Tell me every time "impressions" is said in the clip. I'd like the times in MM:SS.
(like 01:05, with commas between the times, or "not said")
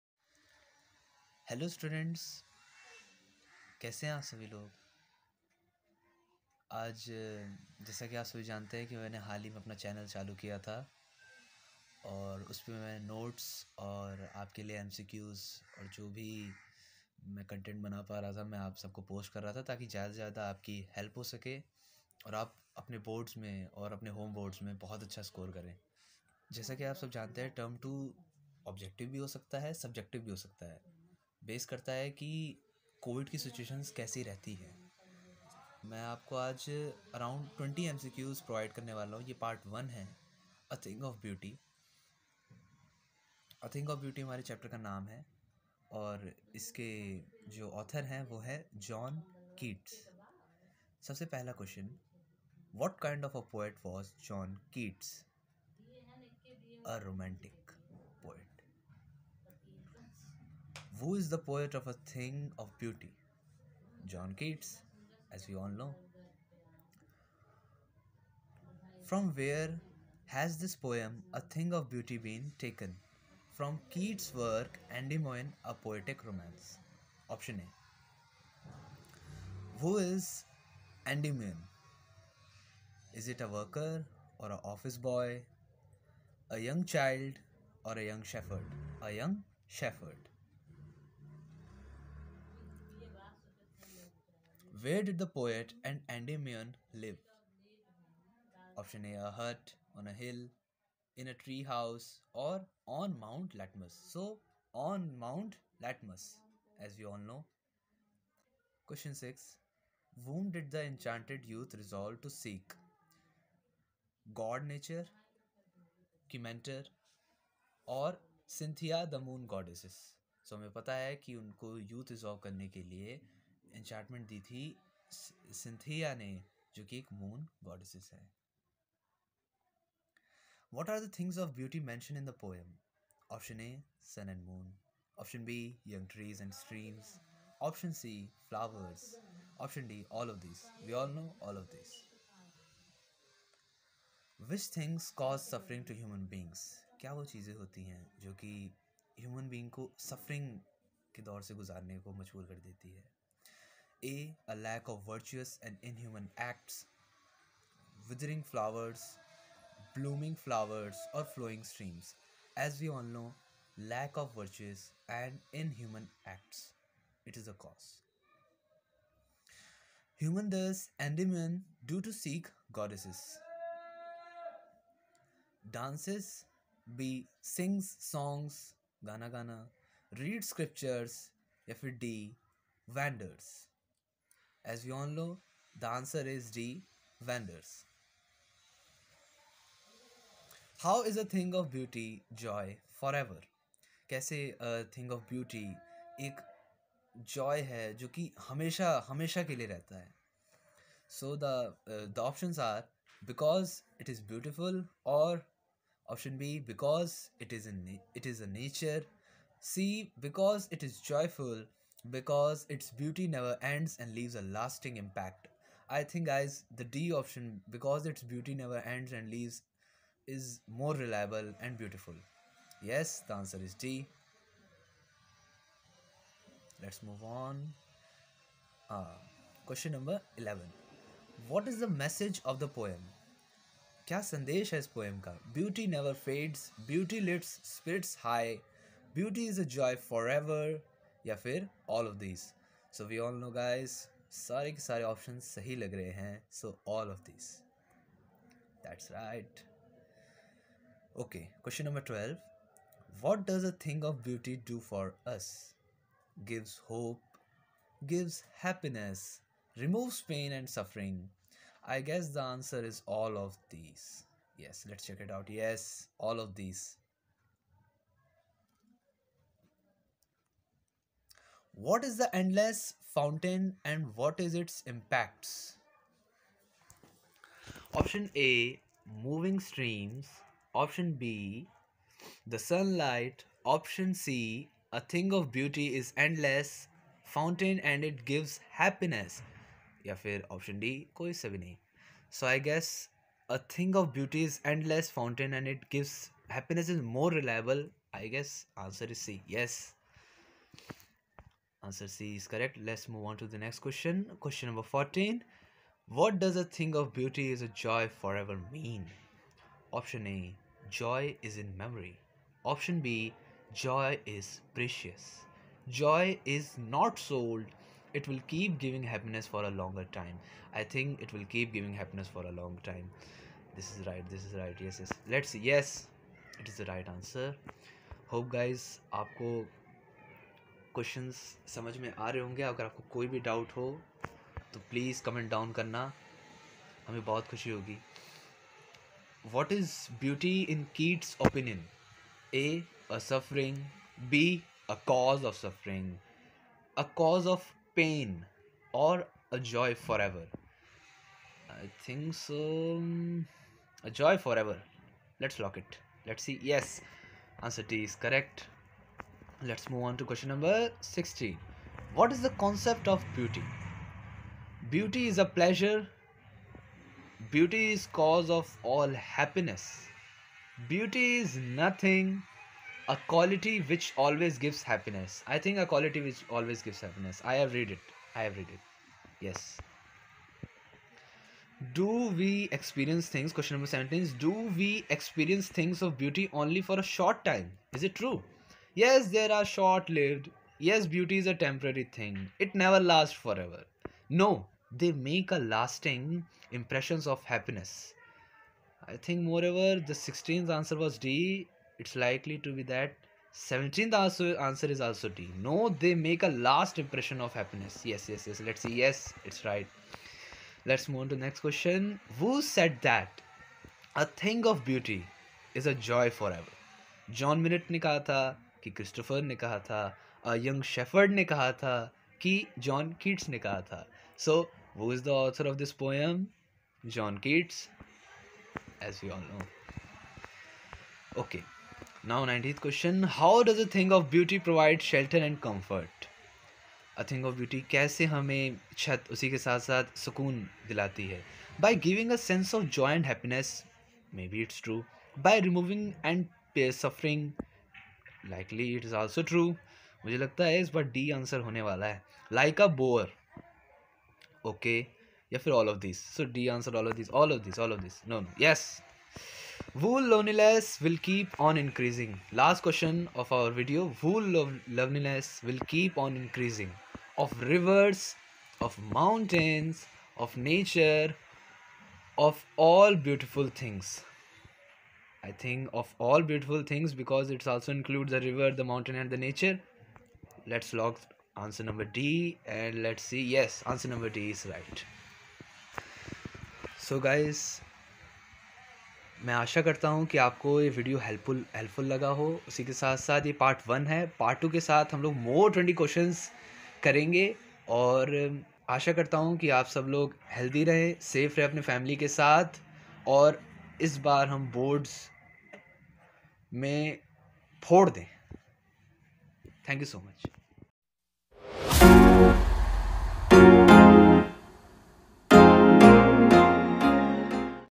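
06:36, 06:46.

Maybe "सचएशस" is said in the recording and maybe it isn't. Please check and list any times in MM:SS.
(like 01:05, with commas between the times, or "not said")
00:33.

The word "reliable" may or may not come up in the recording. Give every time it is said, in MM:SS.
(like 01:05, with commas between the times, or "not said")
03:40, 04:57.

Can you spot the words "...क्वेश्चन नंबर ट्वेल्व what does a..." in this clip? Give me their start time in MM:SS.
04:11.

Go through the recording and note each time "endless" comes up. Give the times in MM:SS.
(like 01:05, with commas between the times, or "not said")
04:32, 04:46, 04:54.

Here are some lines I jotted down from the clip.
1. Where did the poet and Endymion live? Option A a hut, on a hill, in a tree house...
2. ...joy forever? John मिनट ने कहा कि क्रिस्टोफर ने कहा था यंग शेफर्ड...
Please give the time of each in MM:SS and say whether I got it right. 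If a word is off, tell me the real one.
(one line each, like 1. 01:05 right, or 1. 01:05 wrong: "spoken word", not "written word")
1. 01:34 right
2. 06:55 right.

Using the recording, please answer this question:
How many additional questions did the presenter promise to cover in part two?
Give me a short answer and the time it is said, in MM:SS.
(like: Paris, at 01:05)
20, at 08:15.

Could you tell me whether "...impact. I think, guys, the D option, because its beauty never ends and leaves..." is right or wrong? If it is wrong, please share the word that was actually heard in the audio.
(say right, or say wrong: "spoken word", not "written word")
right.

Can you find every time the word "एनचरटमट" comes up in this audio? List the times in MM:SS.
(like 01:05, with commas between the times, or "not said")
02:03.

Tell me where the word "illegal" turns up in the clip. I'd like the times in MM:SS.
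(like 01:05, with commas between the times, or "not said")
not said.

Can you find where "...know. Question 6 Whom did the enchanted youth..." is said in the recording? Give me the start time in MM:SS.
01:47.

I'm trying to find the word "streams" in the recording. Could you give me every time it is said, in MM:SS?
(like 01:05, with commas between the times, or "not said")
02:41, 04:39.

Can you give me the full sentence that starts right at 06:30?
Yes, beauty is a temporary thing.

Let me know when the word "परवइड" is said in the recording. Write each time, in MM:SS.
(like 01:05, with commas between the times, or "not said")
00:38, 07:14.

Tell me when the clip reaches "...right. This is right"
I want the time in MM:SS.
05:24.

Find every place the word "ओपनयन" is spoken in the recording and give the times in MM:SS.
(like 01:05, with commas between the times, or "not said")
05:41.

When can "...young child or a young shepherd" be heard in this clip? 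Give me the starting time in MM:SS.
01:26.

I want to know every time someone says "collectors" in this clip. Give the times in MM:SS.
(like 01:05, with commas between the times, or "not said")
not said.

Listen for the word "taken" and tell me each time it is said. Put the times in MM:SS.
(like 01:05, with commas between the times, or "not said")
01:12.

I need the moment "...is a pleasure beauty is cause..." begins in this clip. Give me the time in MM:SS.
06:05.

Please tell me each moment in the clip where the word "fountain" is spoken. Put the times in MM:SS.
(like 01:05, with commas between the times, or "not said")
04:33, 04:47, 04:55.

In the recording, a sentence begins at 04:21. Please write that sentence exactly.
I guess the answer is all of these.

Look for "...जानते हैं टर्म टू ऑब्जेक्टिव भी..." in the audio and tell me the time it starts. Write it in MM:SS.
00:27.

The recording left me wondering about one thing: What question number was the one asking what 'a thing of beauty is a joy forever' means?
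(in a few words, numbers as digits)
14.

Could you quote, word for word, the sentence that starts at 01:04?
John Keats, as we all know.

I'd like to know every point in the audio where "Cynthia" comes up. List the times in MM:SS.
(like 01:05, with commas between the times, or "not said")
01:58.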